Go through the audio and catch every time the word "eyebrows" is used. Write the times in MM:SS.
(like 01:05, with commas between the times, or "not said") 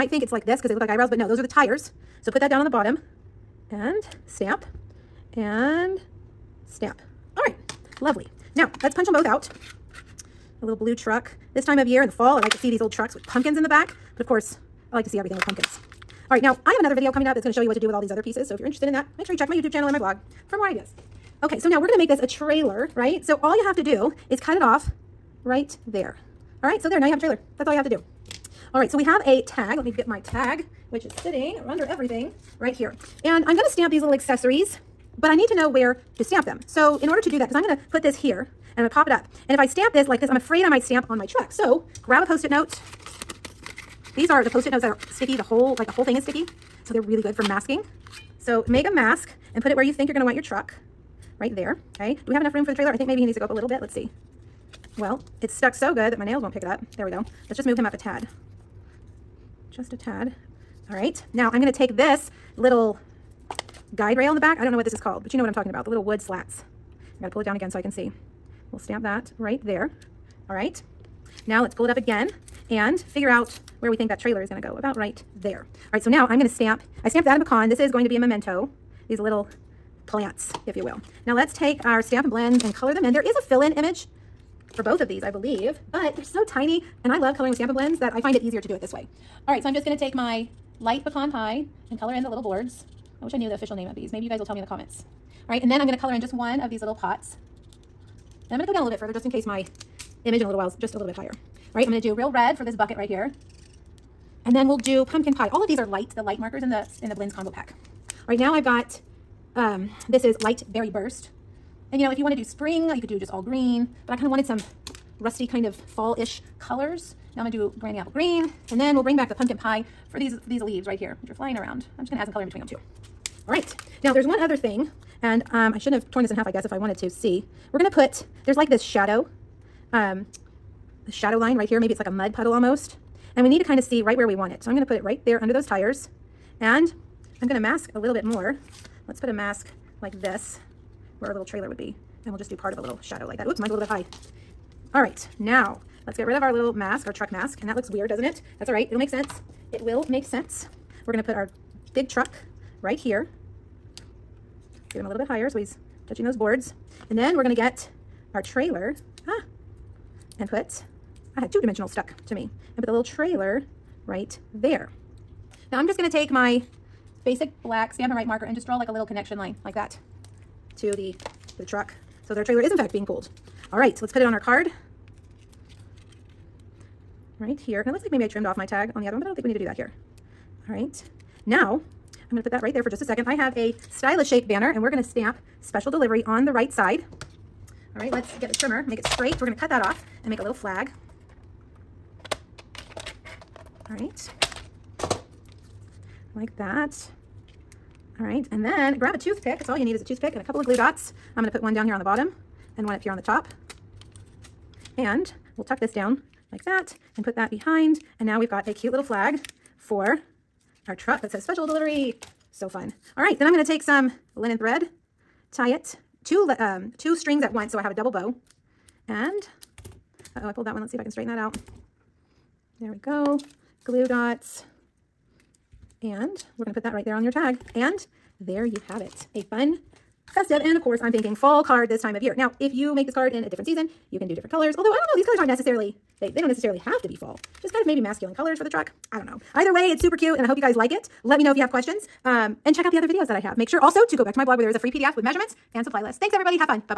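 00:00.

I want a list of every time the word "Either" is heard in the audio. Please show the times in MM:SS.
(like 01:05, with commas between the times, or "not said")
03:59.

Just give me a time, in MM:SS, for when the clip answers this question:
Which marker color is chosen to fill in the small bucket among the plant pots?
01:42.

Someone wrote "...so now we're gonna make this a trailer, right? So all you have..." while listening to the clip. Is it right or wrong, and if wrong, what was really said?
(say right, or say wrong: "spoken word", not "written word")
right.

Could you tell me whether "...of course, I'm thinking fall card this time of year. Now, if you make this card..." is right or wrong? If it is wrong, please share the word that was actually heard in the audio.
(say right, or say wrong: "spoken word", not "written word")
right.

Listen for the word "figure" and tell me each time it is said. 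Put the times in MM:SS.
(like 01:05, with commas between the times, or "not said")
01:12.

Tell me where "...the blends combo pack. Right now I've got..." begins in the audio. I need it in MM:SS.
01:47.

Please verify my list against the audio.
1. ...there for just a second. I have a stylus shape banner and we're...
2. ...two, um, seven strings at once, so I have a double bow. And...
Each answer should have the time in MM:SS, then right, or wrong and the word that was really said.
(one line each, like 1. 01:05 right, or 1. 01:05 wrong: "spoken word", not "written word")
1. 03:02 right
2. 03:36 wrong: "two", not "seven".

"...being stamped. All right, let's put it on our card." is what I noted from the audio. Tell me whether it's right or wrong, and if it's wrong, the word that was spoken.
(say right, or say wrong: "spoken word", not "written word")
wrong: "pulled", not "stamped".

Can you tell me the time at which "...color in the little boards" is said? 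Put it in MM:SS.
01:31.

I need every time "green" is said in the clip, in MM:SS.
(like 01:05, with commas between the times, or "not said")
01:53, 01:58.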